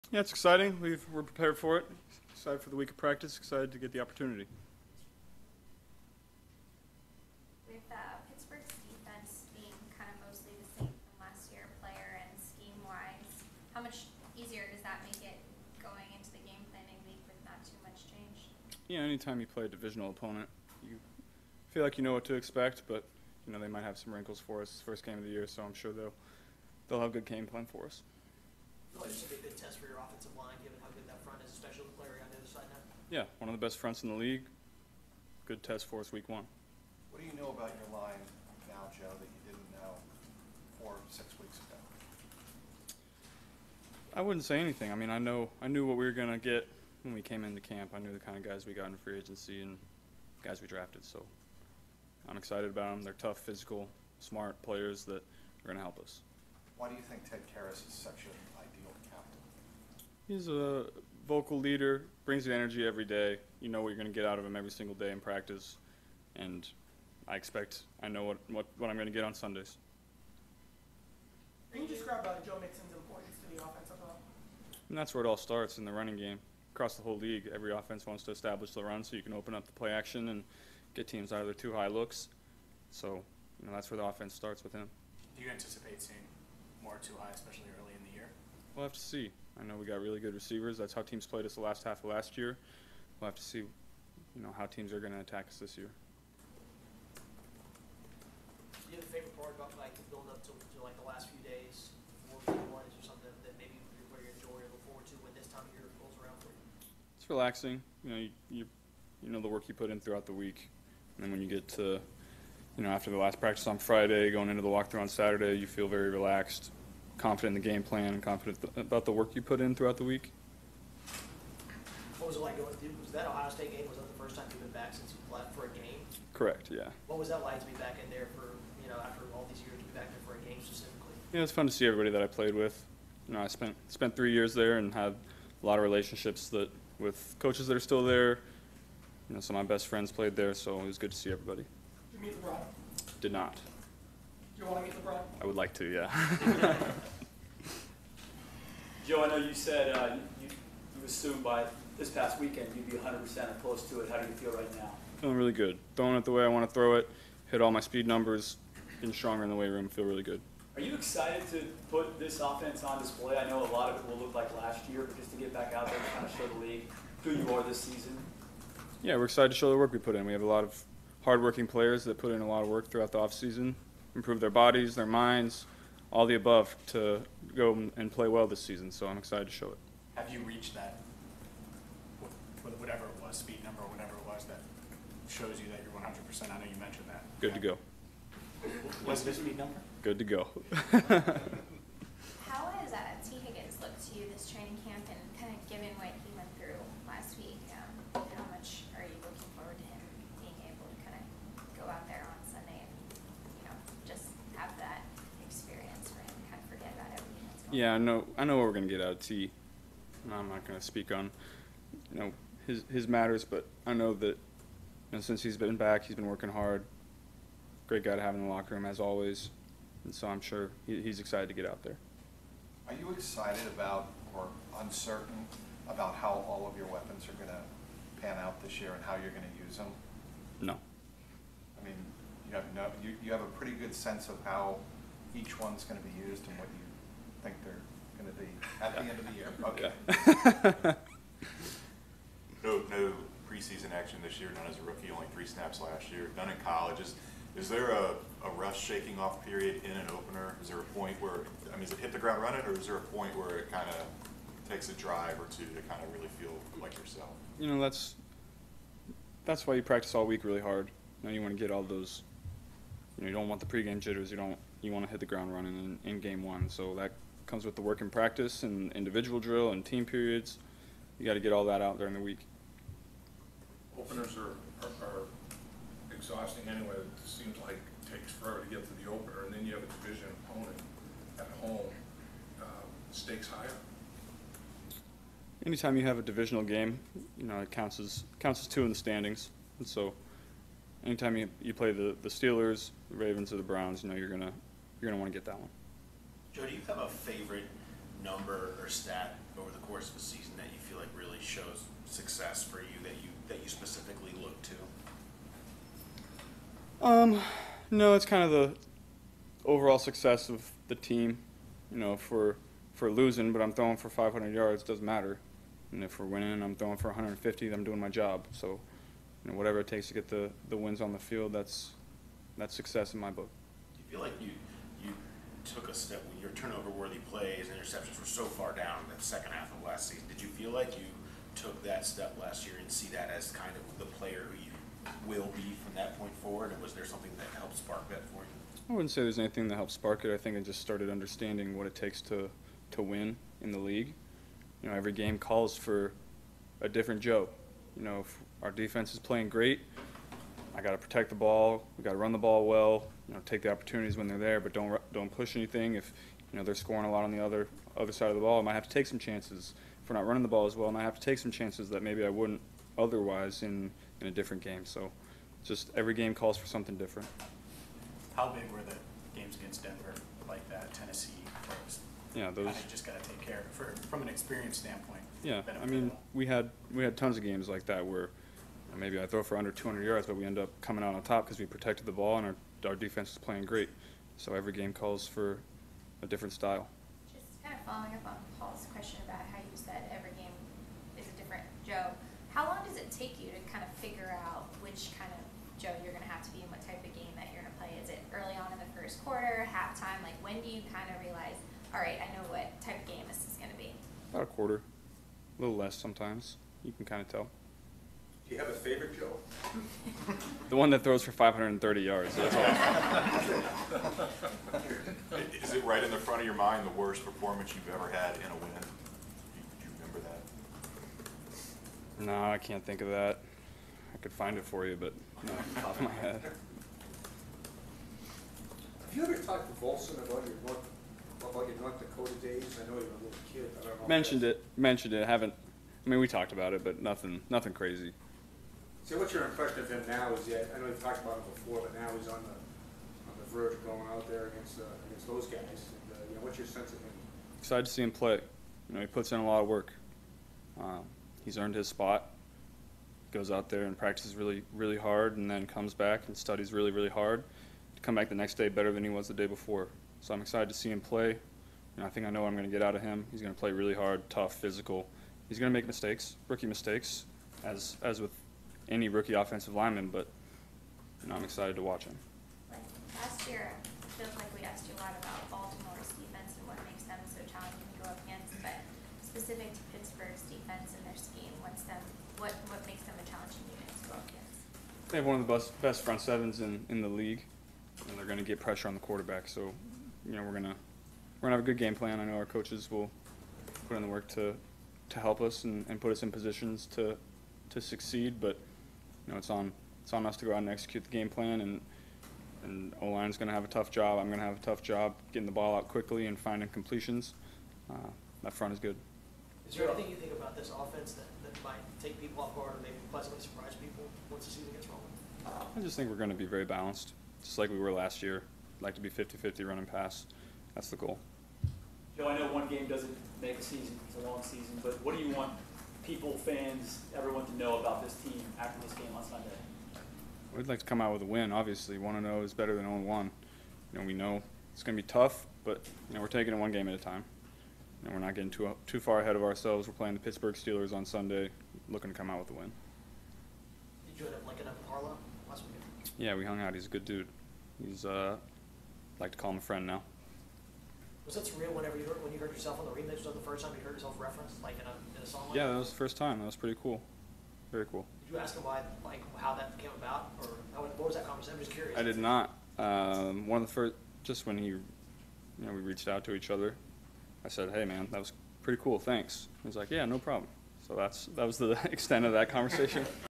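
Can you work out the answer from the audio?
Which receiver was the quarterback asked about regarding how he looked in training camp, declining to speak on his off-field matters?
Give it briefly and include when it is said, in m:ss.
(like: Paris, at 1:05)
Tee Higgins, at 3:13.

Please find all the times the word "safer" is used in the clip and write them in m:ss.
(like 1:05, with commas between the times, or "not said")
not said.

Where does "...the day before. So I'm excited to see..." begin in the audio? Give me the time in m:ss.
7:39.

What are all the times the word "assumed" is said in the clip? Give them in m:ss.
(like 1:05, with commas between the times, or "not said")
2:31.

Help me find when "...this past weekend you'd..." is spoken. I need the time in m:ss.
2:31.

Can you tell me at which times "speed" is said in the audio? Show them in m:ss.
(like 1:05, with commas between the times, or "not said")
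2:37, 3:03, 3:09.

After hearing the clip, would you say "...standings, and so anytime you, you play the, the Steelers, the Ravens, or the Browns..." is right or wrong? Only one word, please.
right.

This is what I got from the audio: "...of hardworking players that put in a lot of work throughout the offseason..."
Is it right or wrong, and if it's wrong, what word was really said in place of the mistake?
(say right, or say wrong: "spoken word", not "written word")
right.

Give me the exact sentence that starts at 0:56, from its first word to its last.
Why do you think Ted Karras' section he's a vocal leader, brings you energy every day.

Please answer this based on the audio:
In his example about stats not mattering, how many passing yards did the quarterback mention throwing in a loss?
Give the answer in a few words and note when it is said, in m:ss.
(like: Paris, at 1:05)
500, at 5:14.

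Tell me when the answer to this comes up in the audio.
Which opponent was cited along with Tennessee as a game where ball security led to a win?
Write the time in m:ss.
6:09.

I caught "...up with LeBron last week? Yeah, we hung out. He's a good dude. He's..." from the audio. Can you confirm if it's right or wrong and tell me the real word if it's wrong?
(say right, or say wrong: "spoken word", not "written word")
wrong: "Harlow", not "LeBron".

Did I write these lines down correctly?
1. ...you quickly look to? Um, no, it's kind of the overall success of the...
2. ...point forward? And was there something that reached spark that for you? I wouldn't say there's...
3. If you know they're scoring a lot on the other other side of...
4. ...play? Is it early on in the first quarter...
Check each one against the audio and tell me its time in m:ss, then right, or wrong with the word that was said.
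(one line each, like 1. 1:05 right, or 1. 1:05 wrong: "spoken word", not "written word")
1. 5:03 wrong: "specifically", not "quickly"
2. 5:36 wrong: "helped", not "reached"
3. 5:55 right
4. 6:37 right.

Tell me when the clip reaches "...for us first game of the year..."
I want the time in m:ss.
0:24.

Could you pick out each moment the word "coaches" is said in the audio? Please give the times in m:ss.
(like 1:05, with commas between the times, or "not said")
2:17, 8:12.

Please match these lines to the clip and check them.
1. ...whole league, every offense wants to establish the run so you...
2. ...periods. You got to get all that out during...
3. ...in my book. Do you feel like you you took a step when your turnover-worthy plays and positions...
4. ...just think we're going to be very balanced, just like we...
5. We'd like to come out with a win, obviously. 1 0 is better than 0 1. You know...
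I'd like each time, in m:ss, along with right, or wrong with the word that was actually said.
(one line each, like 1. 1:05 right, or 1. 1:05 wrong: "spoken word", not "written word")
1. 1:17 right
2. 4:30 right
3. 5:23 wrong: "interceptions", not "positions"
4. 8:35 right
5. 8:50 right.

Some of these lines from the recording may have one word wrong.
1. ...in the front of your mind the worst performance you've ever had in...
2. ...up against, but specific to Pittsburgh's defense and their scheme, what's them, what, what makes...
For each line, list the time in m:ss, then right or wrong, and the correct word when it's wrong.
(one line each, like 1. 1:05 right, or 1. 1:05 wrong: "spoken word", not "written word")
1. 6:56 right
2. 7:58 right.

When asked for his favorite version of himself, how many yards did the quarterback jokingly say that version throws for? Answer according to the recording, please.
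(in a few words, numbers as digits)
530.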